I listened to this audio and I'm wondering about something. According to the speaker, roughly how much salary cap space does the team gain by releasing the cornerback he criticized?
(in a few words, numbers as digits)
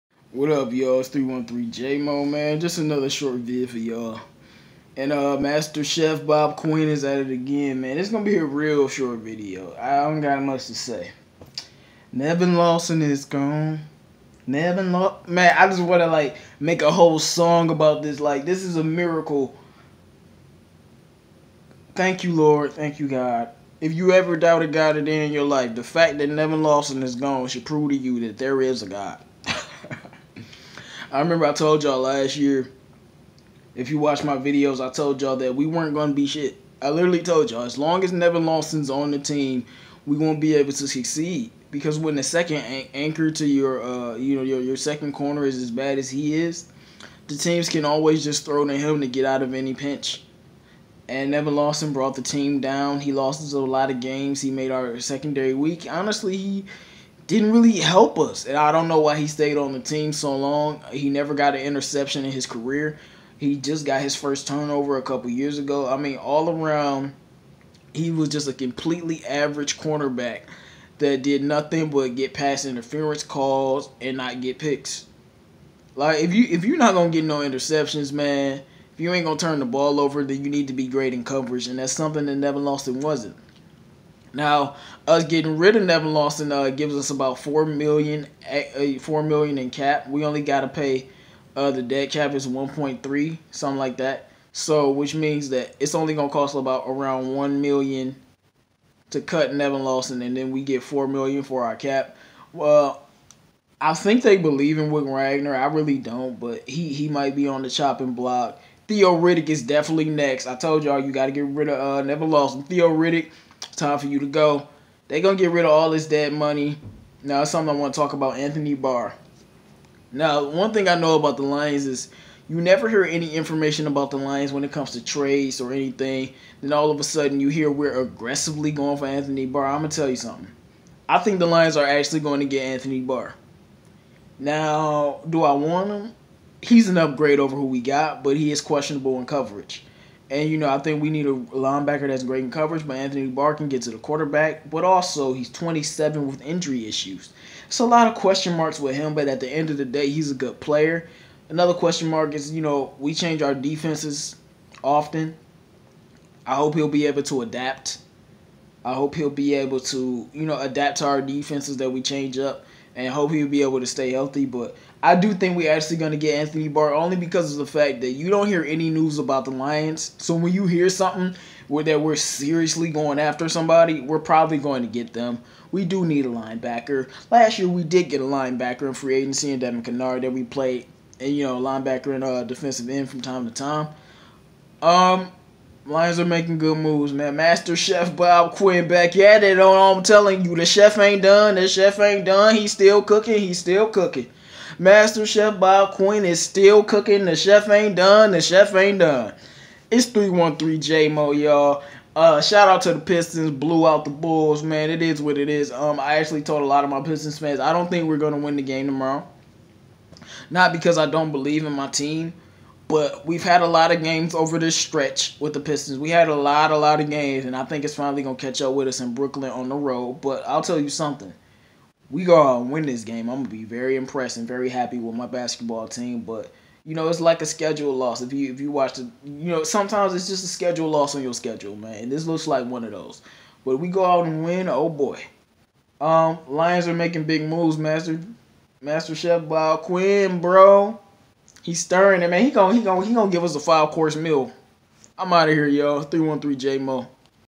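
4 million.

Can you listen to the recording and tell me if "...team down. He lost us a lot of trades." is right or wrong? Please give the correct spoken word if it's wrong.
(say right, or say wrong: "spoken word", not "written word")
wrong: "games", not "trades".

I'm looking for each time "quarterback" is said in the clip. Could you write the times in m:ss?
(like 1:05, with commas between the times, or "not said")
2:23.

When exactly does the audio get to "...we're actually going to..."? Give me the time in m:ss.
2:45.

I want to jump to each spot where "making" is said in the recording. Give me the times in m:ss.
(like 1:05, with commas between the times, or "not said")
3:06, 3:56.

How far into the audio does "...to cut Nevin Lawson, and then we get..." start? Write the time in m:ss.
1:39.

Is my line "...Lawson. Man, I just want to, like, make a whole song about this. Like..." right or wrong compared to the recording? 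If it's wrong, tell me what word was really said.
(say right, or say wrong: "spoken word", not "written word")
right.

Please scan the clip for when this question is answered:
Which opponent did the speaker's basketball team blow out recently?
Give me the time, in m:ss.
3:24.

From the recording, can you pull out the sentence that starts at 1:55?
They're going to get rid of all this dead money.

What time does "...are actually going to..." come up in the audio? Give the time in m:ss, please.
2:11.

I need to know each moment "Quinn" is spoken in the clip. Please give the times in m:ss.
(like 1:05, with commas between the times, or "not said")
0:06, 3:08, 3:15, 3:59.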